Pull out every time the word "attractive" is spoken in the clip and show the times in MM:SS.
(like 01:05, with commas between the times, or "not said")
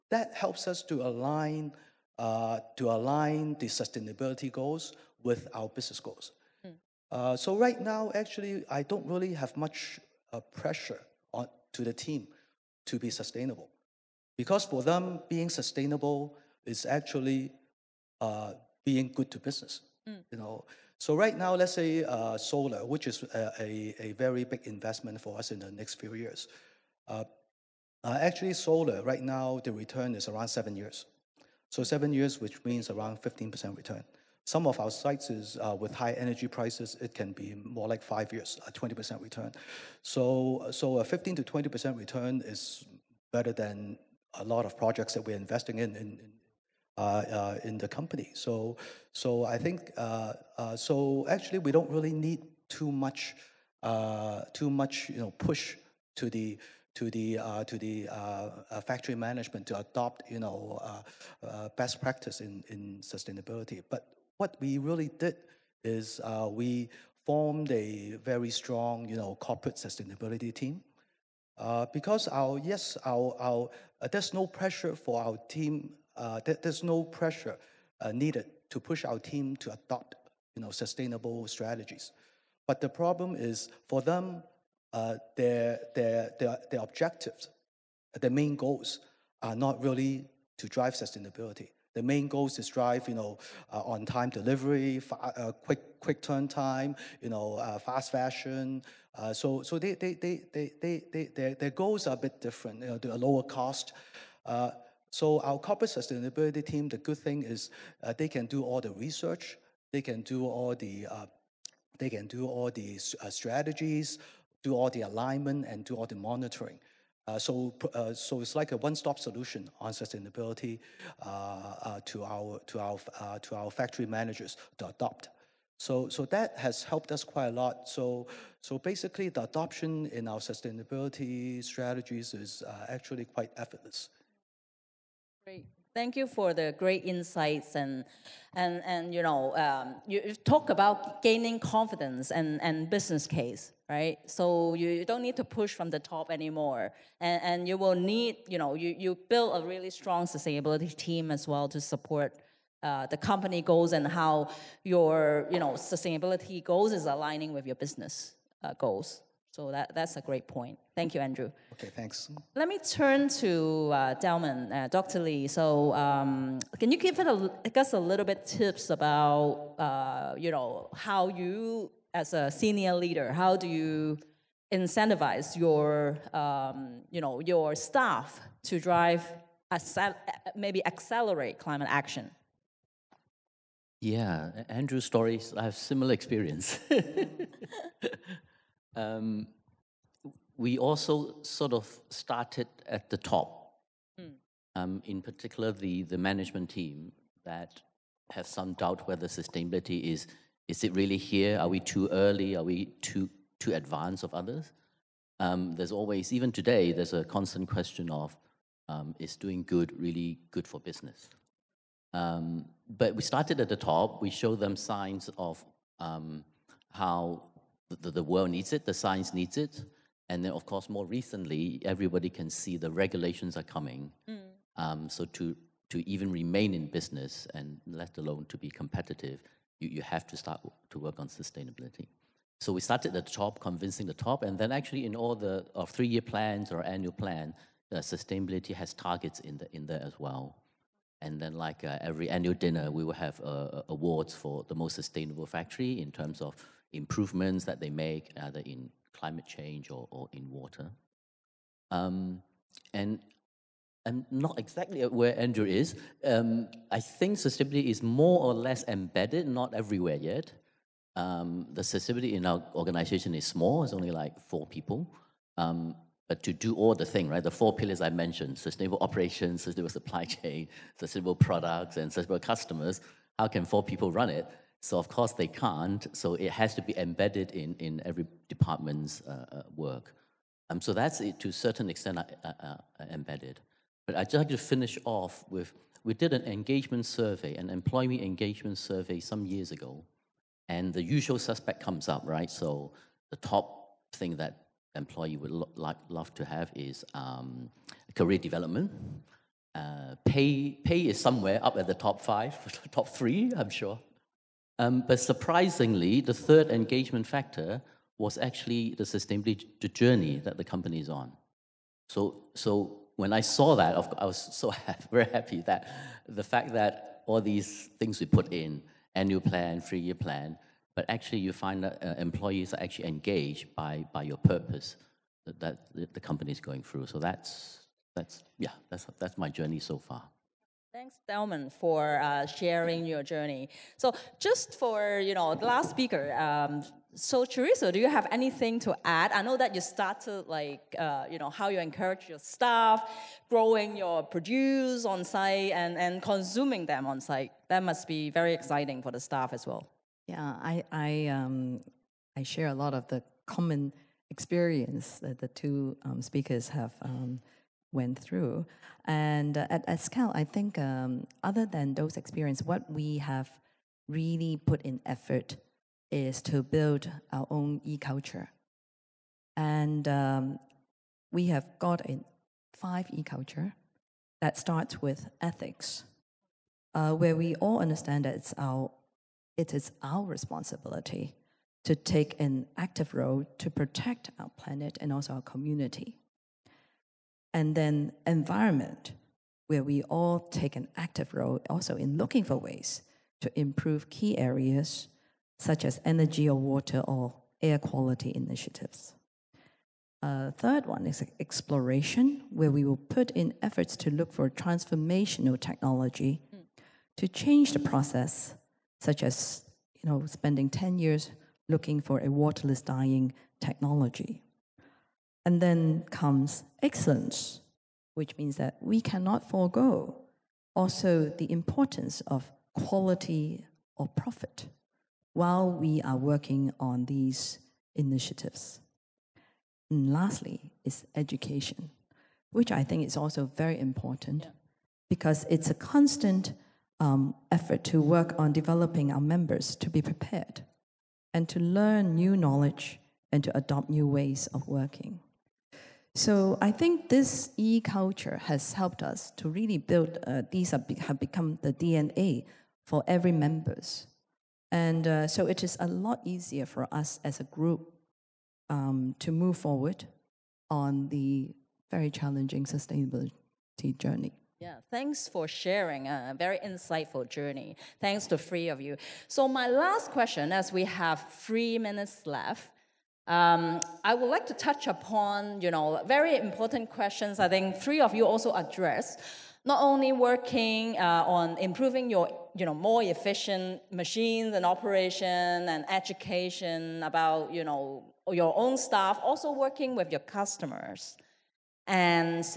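not said.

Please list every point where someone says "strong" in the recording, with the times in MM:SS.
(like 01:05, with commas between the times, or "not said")
01:08, 02:29.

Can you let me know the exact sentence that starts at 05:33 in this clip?
So, just for you know, the last speaker.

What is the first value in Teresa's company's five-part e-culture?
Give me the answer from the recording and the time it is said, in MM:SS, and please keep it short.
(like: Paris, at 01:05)
ethics, at 06:15.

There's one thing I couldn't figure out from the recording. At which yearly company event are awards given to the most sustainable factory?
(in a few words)
annual dinner.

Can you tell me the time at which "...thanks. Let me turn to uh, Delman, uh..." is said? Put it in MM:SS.
02:41.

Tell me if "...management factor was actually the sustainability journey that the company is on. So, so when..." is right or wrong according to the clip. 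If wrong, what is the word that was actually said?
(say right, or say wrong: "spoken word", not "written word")
wrong: "engagement", not "management".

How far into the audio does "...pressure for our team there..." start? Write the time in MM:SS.
01:14.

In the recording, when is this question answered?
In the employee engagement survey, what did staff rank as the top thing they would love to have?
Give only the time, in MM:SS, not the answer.
04:58.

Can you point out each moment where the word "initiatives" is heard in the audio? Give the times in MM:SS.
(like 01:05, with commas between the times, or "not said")
06:38, 07:07.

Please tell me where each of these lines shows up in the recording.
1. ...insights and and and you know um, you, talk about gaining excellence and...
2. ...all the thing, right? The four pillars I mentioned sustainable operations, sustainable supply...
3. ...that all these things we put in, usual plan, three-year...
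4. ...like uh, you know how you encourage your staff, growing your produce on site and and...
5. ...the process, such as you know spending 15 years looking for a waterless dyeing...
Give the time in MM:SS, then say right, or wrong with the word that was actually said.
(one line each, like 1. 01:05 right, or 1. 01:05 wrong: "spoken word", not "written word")
1. 02:17 wrong: "confidence", not "excellence"
2. 04:26 right
3. 05:16 wrong: "annual", not "usual"
4. 05:40 right
5. 06:47 wrong: "10", not "15".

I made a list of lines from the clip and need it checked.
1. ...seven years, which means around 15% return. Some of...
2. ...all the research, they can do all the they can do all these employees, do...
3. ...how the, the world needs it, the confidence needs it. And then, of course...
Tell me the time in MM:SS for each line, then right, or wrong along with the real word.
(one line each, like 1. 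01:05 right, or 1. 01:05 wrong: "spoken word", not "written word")
1. 00:31 right
2. 01:48 wrong: "strategies", not "employees"
3. 03:36 wrong: "science", not "confidence".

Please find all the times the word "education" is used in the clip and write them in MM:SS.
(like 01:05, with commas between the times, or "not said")
07:11, 08:05.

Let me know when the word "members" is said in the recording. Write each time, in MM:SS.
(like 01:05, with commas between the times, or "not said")
07:19, 07:33.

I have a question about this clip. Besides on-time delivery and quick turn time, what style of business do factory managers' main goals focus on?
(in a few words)
fast fashion.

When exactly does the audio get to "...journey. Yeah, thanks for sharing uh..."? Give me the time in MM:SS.
07:43.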